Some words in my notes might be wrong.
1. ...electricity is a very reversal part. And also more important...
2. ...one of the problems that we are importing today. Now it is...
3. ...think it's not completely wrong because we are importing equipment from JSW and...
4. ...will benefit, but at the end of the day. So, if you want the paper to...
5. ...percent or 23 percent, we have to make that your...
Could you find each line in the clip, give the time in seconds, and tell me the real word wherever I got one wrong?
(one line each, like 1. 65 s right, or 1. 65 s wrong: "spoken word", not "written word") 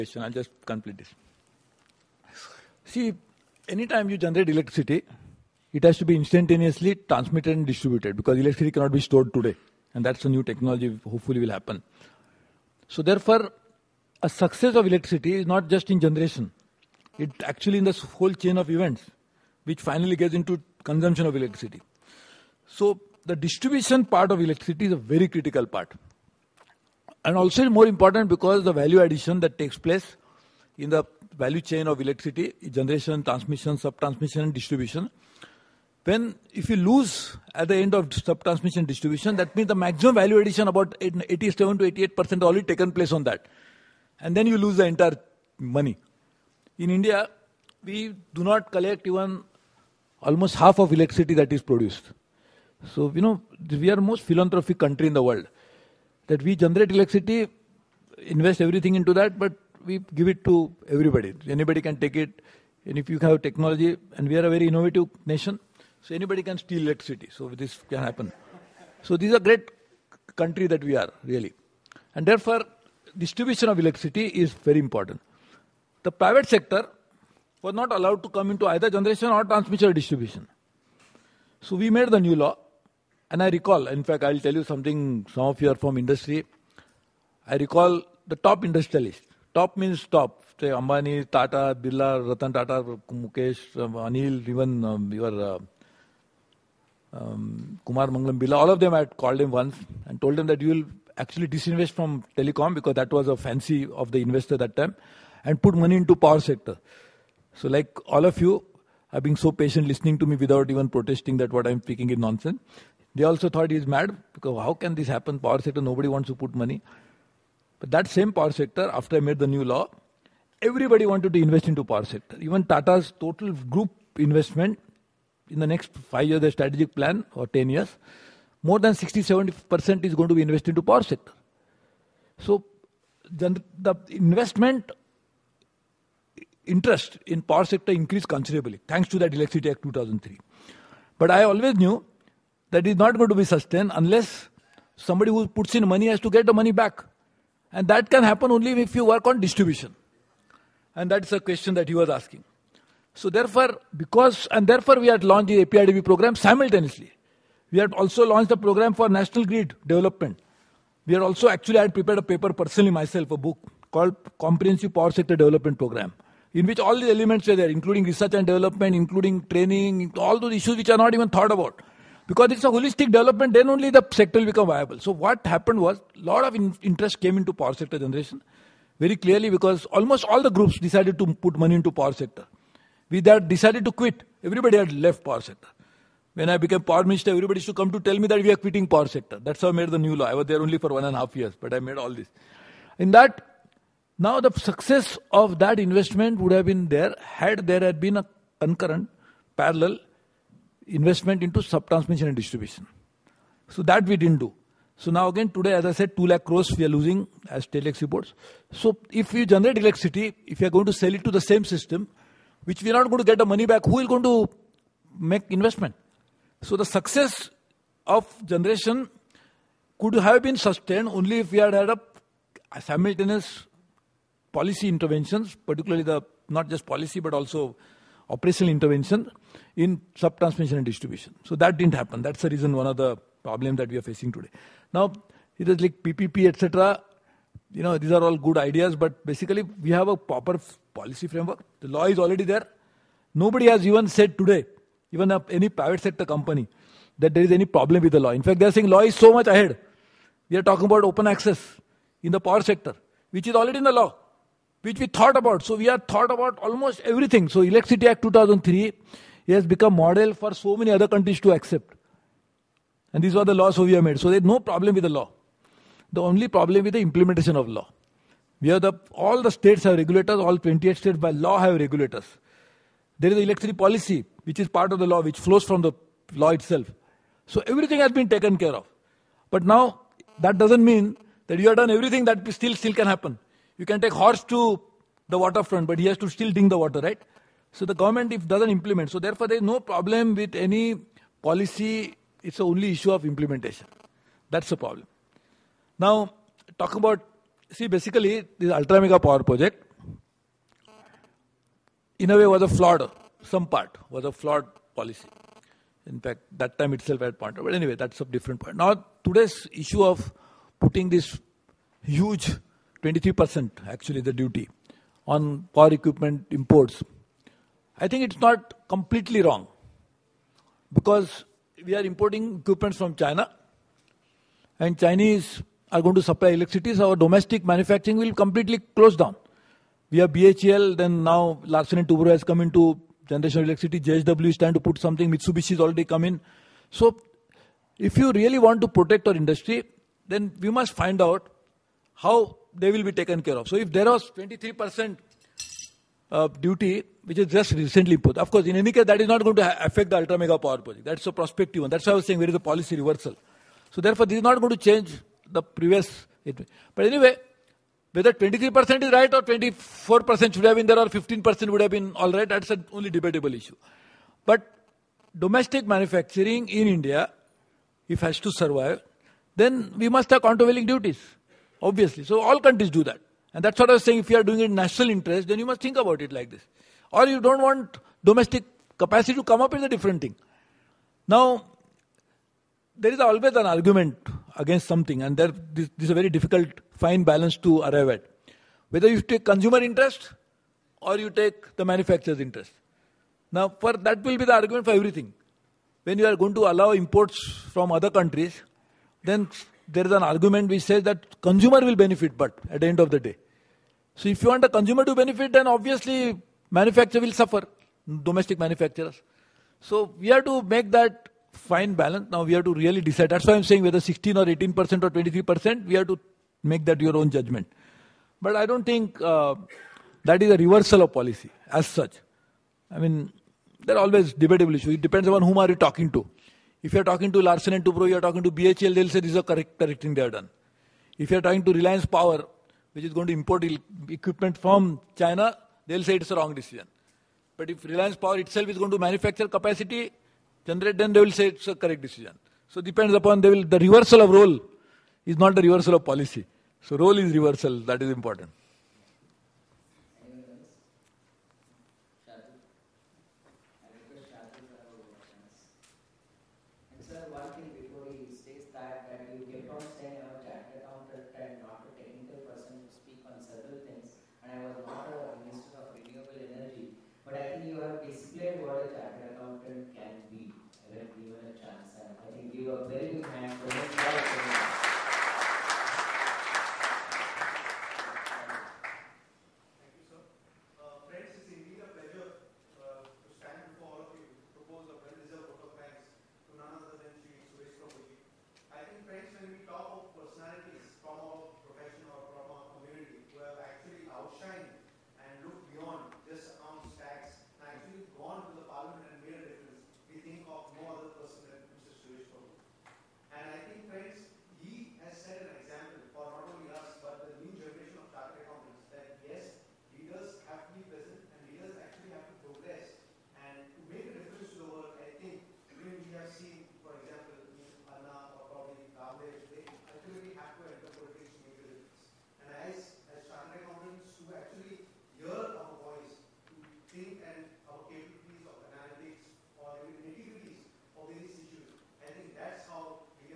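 1. 24 s wrong: "critical", not "reversal"
2. 232 s wrong: "facing", not "importing"
3. 318 s wrong: "China", not "JSW"
4. 401 s wrong: "consumer", not "paper"
5. 414 s right.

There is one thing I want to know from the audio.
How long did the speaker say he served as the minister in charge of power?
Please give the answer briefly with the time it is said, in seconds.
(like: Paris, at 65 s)
one and a half years, at 190 s.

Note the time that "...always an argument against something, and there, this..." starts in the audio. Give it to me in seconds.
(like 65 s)
383 s.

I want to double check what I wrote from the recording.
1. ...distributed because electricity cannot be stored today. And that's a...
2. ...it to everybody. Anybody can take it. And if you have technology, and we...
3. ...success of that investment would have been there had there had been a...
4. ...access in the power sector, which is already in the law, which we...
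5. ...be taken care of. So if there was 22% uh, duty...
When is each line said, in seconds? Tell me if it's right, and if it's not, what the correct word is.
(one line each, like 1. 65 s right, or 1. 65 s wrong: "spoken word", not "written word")
1. 7 s right
2. 60 s right
3. 194 s right
4. 251 s right
5. 343 s wrong: "23", not "22".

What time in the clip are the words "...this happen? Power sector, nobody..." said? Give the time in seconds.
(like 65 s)
114 s.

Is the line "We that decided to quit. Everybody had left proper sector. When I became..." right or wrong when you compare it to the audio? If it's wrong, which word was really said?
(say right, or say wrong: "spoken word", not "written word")
wrong: "power", not "proper".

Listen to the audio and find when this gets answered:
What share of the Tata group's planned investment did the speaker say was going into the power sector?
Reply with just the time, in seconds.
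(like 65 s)
128 s.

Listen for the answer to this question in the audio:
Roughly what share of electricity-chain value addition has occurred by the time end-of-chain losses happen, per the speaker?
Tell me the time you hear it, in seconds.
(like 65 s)
41 s.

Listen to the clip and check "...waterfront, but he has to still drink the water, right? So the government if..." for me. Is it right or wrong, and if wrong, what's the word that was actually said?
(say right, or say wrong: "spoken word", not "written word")
right.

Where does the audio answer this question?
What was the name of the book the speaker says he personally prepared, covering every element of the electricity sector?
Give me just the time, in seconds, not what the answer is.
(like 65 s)
164 s.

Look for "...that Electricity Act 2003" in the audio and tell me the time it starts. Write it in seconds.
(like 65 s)
139 s.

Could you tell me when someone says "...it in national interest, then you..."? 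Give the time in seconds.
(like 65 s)
374 s.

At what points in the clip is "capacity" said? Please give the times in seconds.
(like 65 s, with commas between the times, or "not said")
378 s, 439 s.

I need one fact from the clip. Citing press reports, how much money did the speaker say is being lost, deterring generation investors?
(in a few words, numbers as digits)
2 lakh crores.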